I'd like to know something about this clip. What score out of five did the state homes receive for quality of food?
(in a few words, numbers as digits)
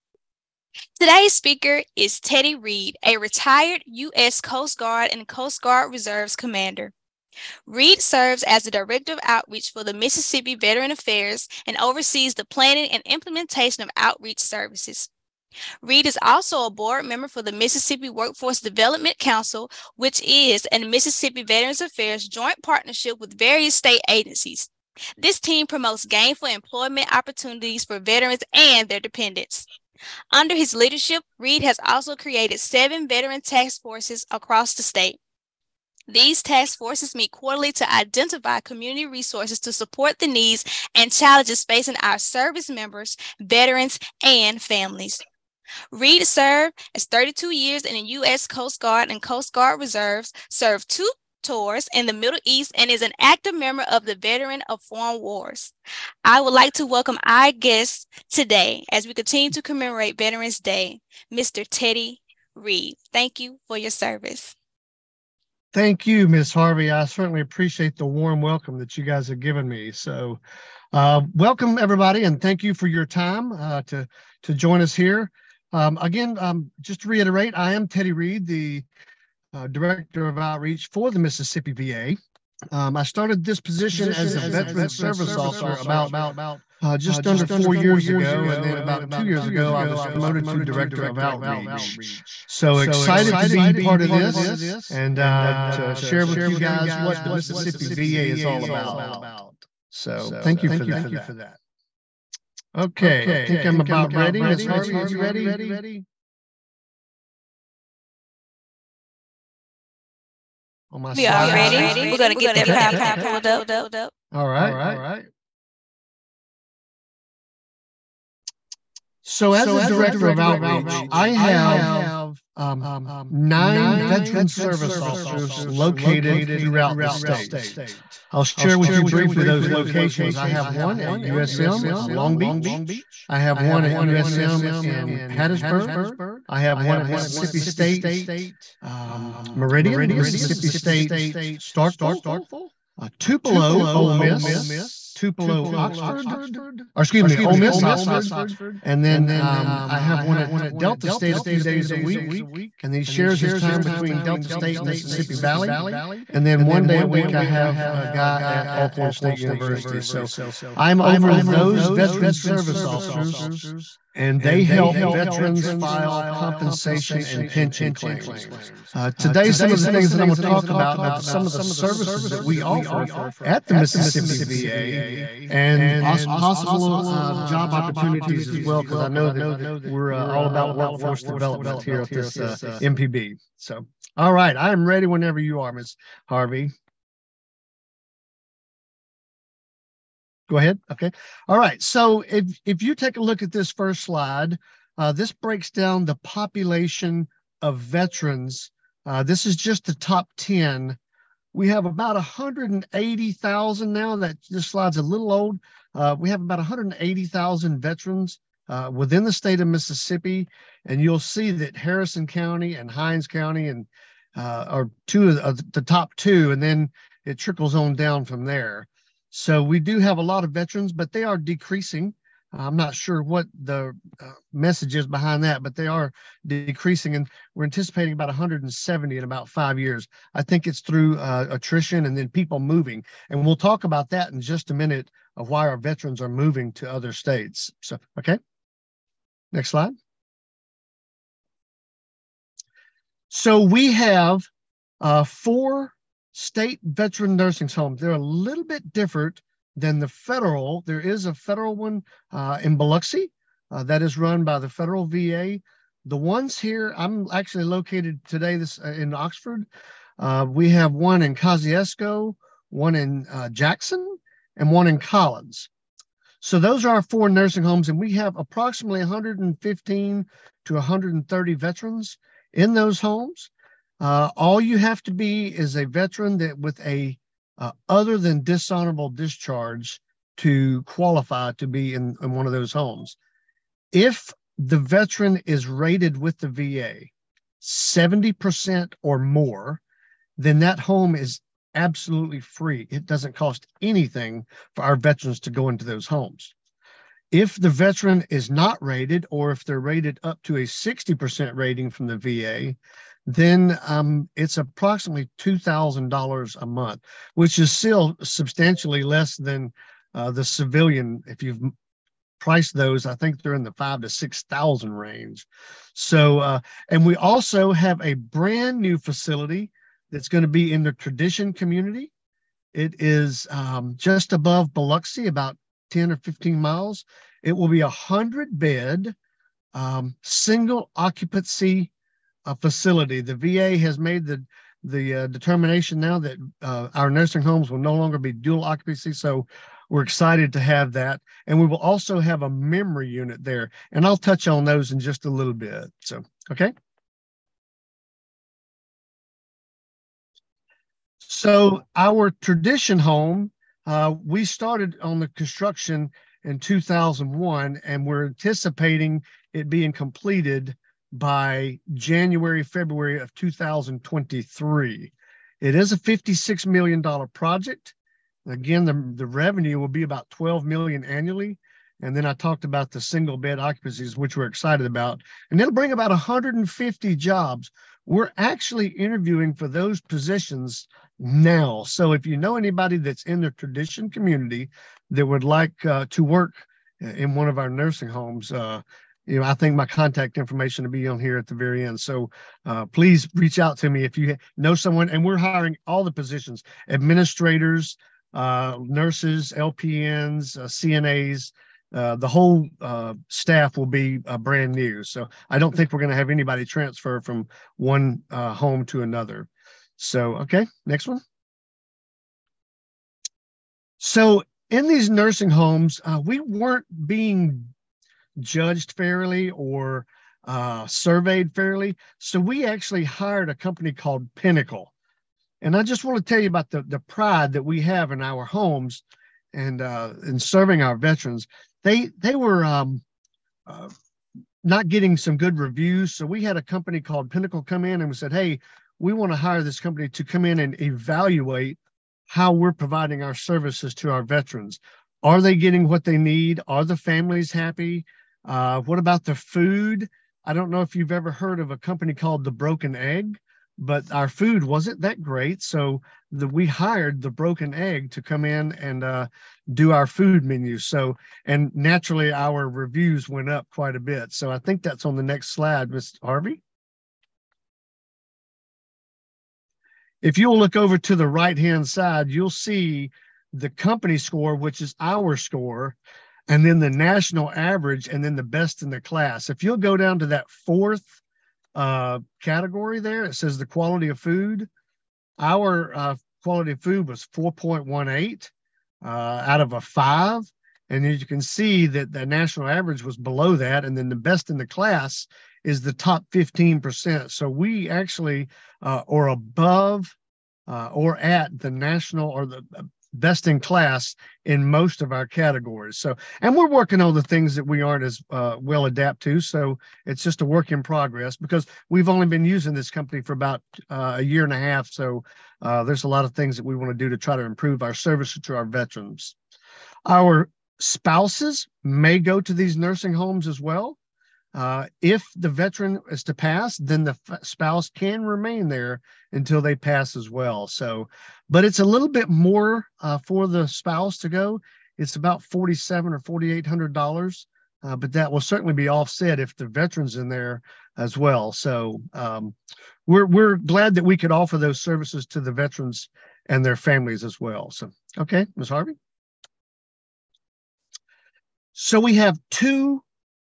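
4.18.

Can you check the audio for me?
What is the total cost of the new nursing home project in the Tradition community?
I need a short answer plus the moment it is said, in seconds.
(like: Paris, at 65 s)
$56 million, at 365 s.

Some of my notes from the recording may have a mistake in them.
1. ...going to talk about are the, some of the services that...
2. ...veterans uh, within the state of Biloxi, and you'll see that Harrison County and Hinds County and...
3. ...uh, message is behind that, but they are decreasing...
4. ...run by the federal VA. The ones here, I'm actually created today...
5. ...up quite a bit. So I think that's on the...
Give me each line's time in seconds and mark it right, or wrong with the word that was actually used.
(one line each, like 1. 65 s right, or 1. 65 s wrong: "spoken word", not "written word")
1. 170 s right
2. 207 s wrong: "Mississippi", not "Biloxi"
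3. 224 s right
4. 254 s wrong: "located", not "created"
5. 463 s right.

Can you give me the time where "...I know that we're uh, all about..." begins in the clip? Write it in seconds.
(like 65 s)
179 s.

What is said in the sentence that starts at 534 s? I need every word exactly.
It's about forty-seven or forty-eight hundred dollars, uh, but that will certainly be offset if the veteran's in there as well.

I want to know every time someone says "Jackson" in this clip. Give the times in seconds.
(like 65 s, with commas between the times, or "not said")
263 s.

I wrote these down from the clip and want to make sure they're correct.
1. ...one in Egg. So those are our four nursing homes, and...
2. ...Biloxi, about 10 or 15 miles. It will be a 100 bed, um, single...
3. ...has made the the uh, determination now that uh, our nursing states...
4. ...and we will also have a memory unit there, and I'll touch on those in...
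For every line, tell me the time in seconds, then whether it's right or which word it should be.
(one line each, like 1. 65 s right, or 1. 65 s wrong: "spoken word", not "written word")
1. 264 s wrong: "Collins", not "Egg"
2. 324 s right
3. 333 s wrong: "homes", not "states"
4. 341 s right.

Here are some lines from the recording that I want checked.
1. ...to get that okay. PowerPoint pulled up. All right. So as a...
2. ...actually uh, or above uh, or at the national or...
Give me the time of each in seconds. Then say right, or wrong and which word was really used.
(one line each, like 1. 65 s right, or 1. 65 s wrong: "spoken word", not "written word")
1. 112 s right
2. 497 s right.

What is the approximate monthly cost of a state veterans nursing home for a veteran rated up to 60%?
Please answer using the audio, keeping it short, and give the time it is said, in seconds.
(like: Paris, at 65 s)
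$2,000, at 305 s.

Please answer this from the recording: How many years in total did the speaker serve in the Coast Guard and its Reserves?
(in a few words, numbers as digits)
32.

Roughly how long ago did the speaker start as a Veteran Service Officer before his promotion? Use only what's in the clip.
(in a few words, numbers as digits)
just under 4 years.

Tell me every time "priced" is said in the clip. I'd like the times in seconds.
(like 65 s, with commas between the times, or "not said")
312 s.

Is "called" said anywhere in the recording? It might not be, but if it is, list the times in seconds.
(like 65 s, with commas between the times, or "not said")
423 s, 437 s, 452 s.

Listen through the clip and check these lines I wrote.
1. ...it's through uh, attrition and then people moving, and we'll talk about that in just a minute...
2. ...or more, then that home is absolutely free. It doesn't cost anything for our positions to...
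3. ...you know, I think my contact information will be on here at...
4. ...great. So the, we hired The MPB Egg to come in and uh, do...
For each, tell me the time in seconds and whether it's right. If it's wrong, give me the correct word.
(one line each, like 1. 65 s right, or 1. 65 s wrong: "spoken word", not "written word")
1. 230 s right
2. 289 s wrong: "veterans", not "positions"
3. 389 s right
4. 455 s wrong: "Broken", not "MPB".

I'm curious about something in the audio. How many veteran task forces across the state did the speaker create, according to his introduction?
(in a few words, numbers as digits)
7.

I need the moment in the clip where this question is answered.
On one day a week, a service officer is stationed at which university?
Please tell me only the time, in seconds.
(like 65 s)
158 s.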